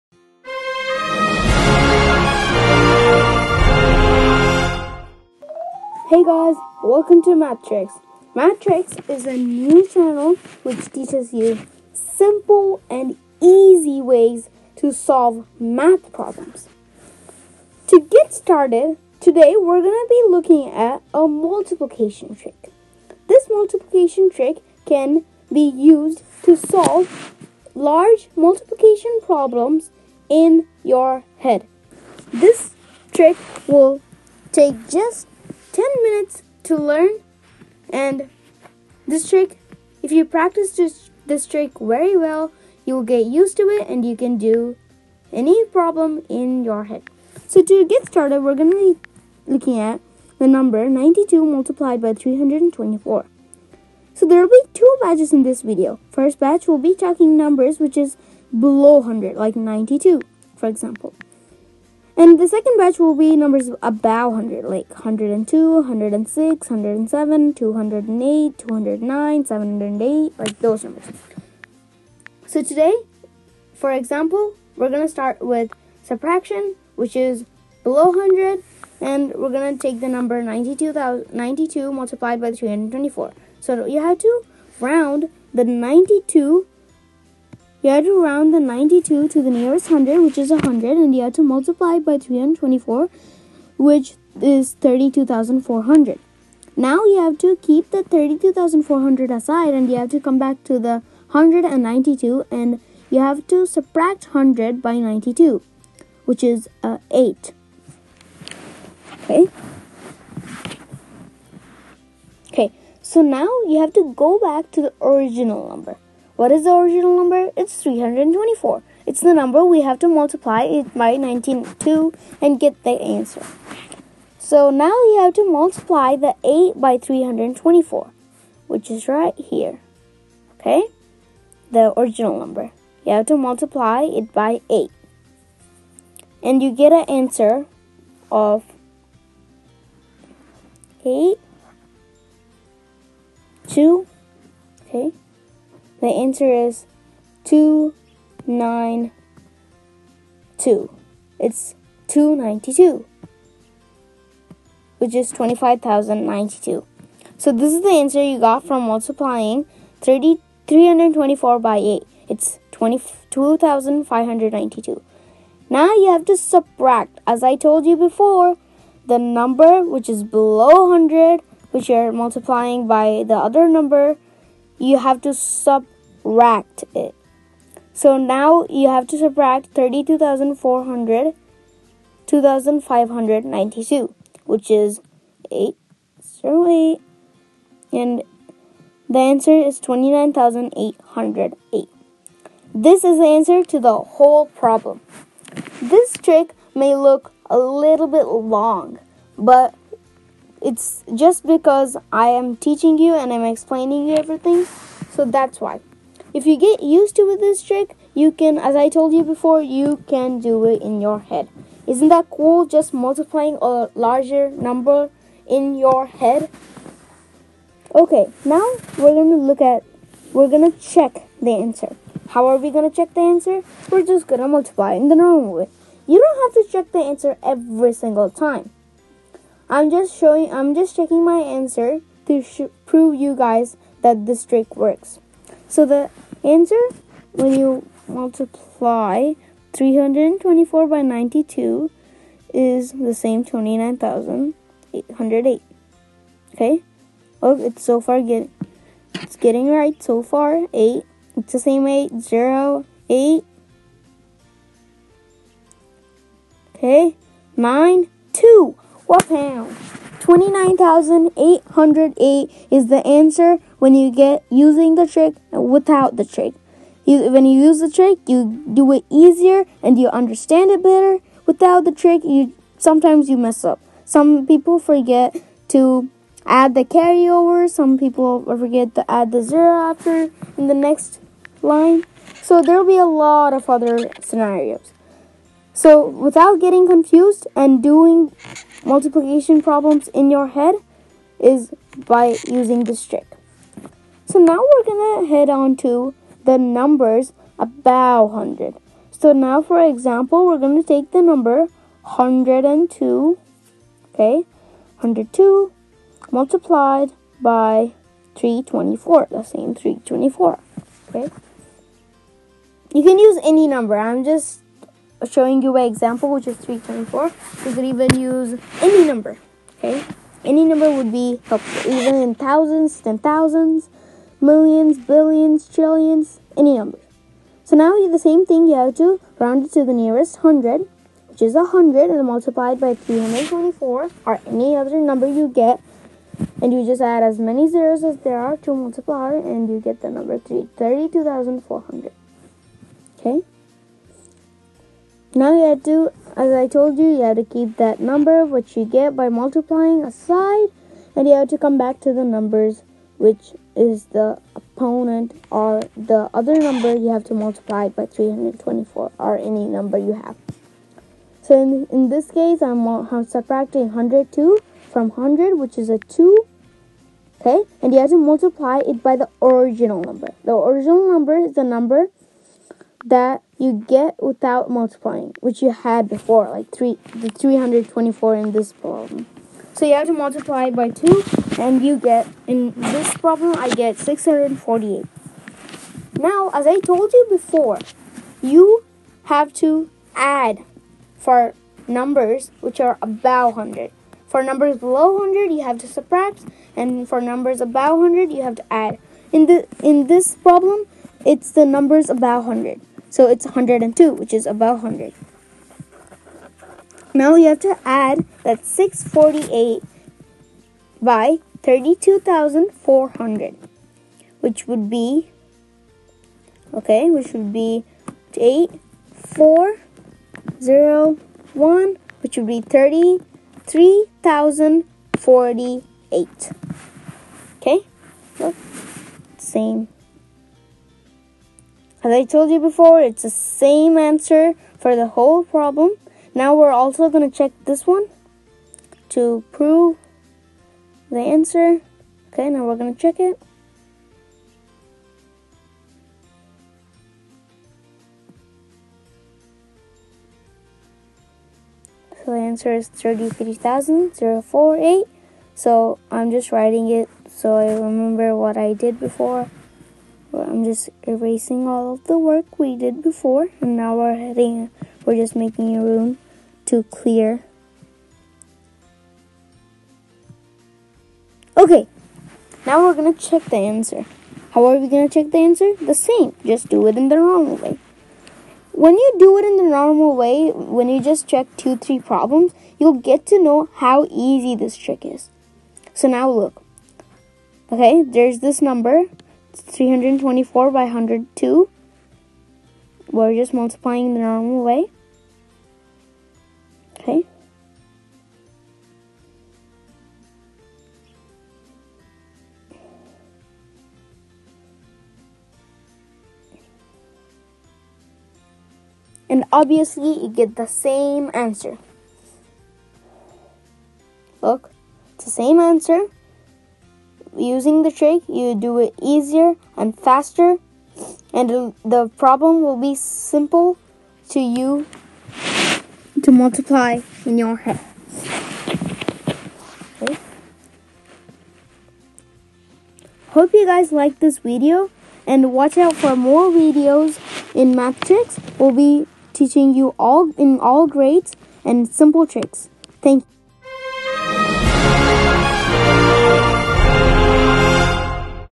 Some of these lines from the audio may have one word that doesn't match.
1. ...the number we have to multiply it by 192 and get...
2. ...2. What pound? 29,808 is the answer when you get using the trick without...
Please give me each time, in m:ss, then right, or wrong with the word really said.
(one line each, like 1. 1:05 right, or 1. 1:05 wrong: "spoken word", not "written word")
1. 1:59 right
2. 4:18 right.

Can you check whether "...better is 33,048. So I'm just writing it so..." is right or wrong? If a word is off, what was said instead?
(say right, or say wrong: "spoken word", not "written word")
wrong: "answer", not "better".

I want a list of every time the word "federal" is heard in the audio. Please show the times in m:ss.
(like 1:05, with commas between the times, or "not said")
not said.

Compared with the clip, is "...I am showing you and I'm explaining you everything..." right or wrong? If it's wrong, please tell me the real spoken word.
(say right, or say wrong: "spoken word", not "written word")
wrong: "teaching", not "showing".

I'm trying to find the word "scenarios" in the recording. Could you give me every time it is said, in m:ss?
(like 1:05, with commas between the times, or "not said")
4:44.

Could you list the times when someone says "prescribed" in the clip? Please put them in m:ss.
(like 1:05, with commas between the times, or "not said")
not said.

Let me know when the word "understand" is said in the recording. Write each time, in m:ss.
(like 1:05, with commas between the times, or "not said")
4:30.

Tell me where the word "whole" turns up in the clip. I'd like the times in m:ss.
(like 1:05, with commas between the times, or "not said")
3:13, 7:15.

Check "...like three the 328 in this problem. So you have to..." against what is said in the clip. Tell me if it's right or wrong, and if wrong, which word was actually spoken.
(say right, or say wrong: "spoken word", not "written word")
wrong: "324", not "328".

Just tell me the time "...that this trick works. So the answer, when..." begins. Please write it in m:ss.
3:54.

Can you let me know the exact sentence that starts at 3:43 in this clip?
We're just gonna multiply in the normal way.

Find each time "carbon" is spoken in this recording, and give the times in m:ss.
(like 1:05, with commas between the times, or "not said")
not said.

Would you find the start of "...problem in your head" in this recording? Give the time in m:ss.
0:45.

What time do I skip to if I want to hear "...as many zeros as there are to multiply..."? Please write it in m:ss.
5:37.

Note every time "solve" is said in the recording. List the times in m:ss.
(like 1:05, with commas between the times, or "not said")
0:14, 0:26.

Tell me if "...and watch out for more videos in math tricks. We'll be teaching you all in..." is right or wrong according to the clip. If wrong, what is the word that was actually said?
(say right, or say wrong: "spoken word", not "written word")
right.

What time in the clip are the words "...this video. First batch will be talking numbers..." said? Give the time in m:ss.
0:55.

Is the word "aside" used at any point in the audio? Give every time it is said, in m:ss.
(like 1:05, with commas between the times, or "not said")
1:39, 5:50.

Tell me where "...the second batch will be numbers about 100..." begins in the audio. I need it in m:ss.
1:02.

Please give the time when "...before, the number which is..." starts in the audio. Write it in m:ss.
2:47.